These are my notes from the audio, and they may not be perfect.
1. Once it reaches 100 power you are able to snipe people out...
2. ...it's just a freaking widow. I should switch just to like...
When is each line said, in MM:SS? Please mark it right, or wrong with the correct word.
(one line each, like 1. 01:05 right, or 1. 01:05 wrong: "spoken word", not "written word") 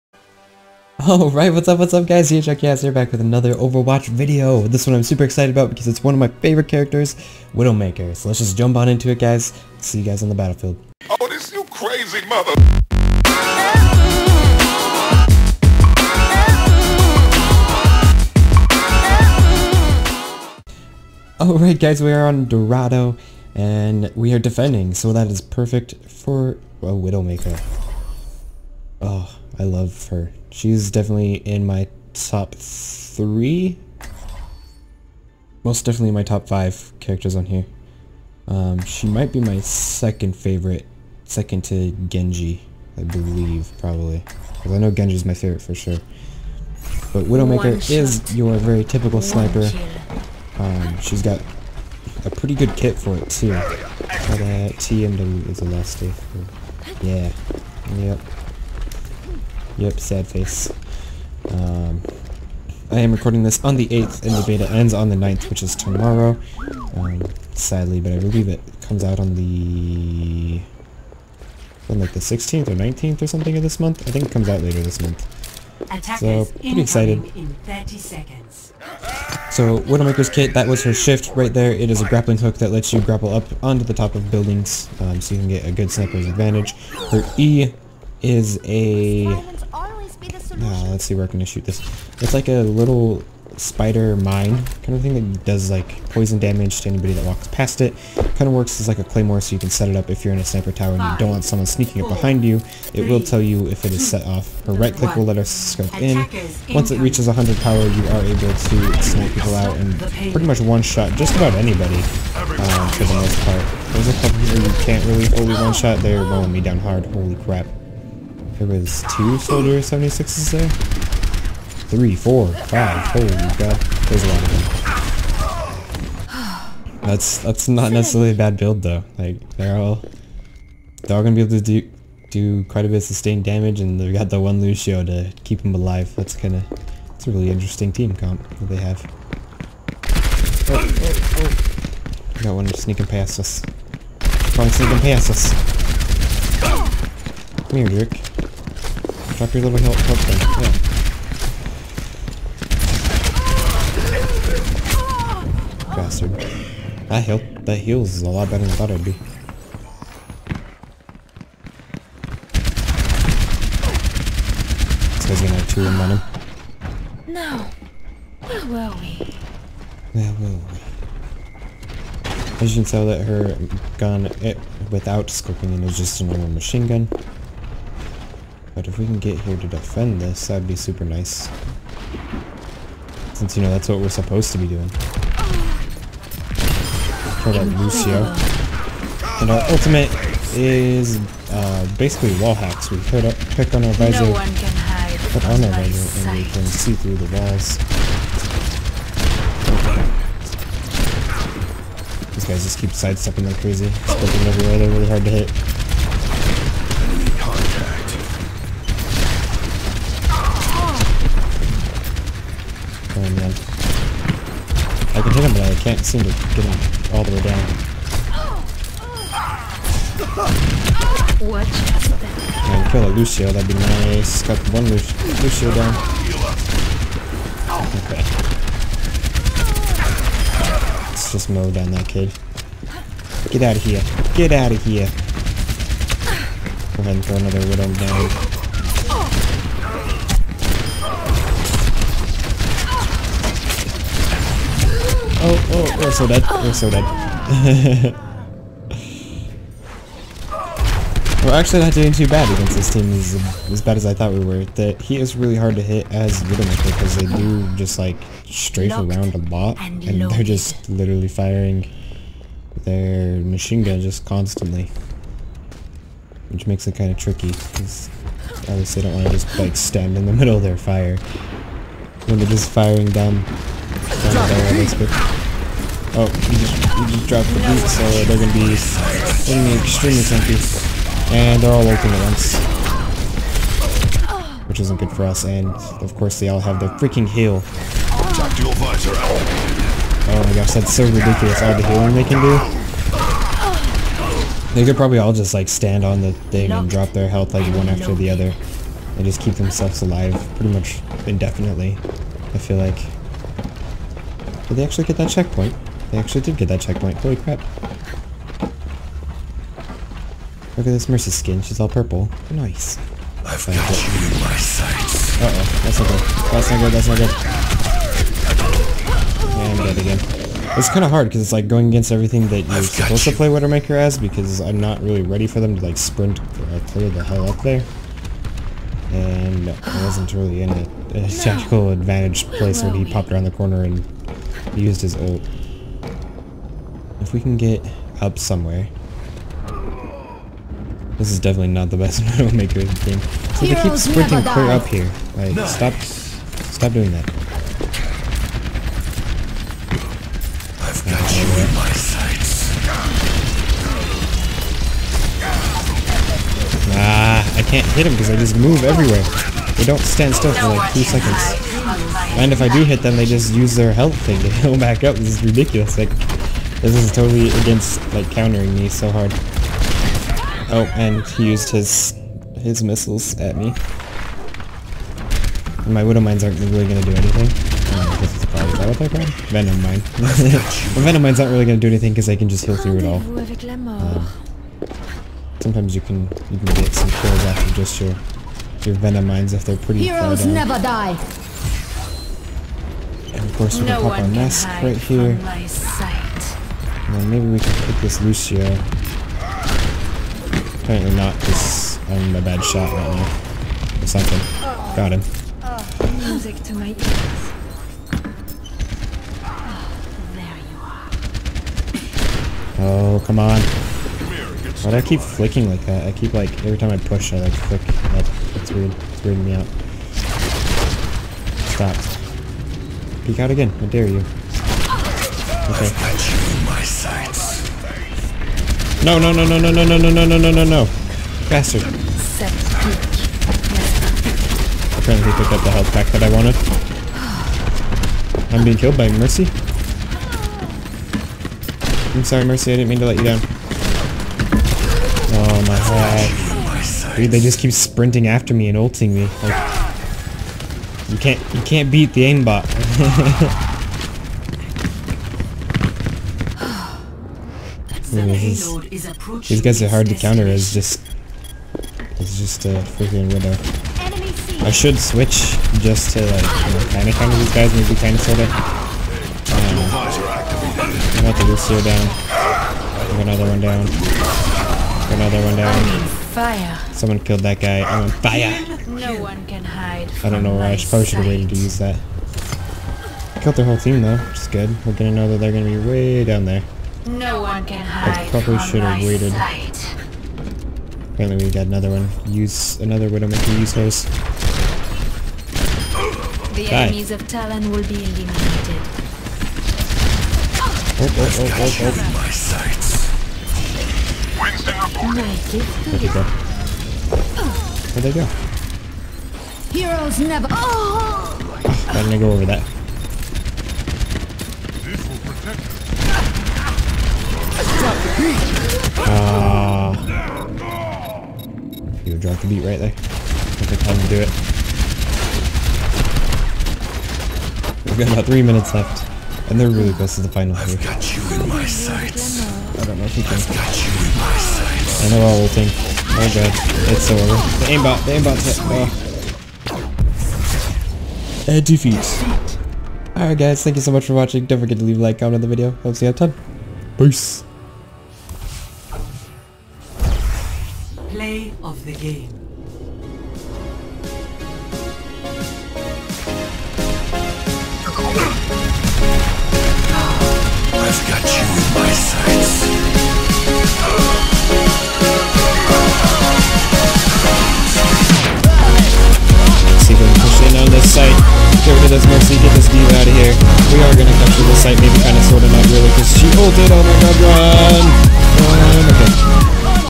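1. 01:46 right
2. 07:42 right.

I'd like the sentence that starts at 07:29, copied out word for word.
Like, you can't you can't beat the aimbot.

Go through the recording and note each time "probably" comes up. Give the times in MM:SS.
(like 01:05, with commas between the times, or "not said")
00:43, 04:54, 06:18, 08:00, 08:08.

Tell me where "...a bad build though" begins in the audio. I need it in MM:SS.
02:08.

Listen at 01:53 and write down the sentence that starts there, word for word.
There's a couple here you can't really fully one shot.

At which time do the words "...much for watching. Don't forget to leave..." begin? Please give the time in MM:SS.
09:03.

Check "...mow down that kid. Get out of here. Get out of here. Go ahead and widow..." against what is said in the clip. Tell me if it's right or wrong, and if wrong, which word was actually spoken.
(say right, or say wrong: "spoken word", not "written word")
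wrong: "throw", not "widow".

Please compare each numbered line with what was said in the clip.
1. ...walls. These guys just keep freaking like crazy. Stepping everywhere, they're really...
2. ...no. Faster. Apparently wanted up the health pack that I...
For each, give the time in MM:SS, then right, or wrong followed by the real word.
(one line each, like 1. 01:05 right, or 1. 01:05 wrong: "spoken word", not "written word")
1. 03:17 wrong: "sidestepping", not "freaking"
2. 07:10 wrong: "picked", not "wanted".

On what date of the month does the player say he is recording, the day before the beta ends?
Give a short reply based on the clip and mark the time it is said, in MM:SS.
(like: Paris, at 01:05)
8th, at 01:03.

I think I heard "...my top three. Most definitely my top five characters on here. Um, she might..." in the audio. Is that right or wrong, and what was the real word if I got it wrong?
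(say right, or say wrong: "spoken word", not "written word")
right.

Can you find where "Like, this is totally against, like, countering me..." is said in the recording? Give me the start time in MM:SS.
06:05.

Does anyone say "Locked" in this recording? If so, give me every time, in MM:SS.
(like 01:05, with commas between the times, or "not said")
04:18.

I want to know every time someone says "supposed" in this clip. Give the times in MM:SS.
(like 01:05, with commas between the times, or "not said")
03:04, 05:22.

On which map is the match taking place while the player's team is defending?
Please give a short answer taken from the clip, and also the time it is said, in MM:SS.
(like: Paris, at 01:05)
Dorado, at 00:22.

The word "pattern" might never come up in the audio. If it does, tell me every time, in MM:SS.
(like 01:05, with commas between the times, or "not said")
not said.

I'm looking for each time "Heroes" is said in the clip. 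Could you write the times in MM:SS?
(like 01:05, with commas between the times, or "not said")
06:30, 08:29.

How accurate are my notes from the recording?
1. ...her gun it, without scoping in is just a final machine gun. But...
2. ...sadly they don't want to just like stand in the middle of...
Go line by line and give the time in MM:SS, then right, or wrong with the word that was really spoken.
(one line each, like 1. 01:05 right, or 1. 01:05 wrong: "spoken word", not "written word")
1. 02:53 wrong: "normal", not "final"
2. 04:28 wrong: "obviously", not "sadly".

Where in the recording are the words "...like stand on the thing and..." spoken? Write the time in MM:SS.
04:55.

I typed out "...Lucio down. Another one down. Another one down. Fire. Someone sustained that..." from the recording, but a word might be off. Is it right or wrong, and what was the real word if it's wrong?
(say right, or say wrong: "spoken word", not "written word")
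wrong: "killed", not "sustained".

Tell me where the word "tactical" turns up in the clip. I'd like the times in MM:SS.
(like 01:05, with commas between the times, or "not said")
05:31.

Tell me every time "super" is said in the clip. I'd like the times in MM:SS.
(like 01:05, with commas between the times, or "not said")
00:05, 03:00.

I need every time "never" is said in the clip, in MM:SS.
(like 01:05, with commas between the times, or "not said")
06:30, 08:30.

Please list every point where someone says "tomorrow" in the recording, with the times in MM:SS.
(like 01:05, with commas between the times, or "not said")
01:05.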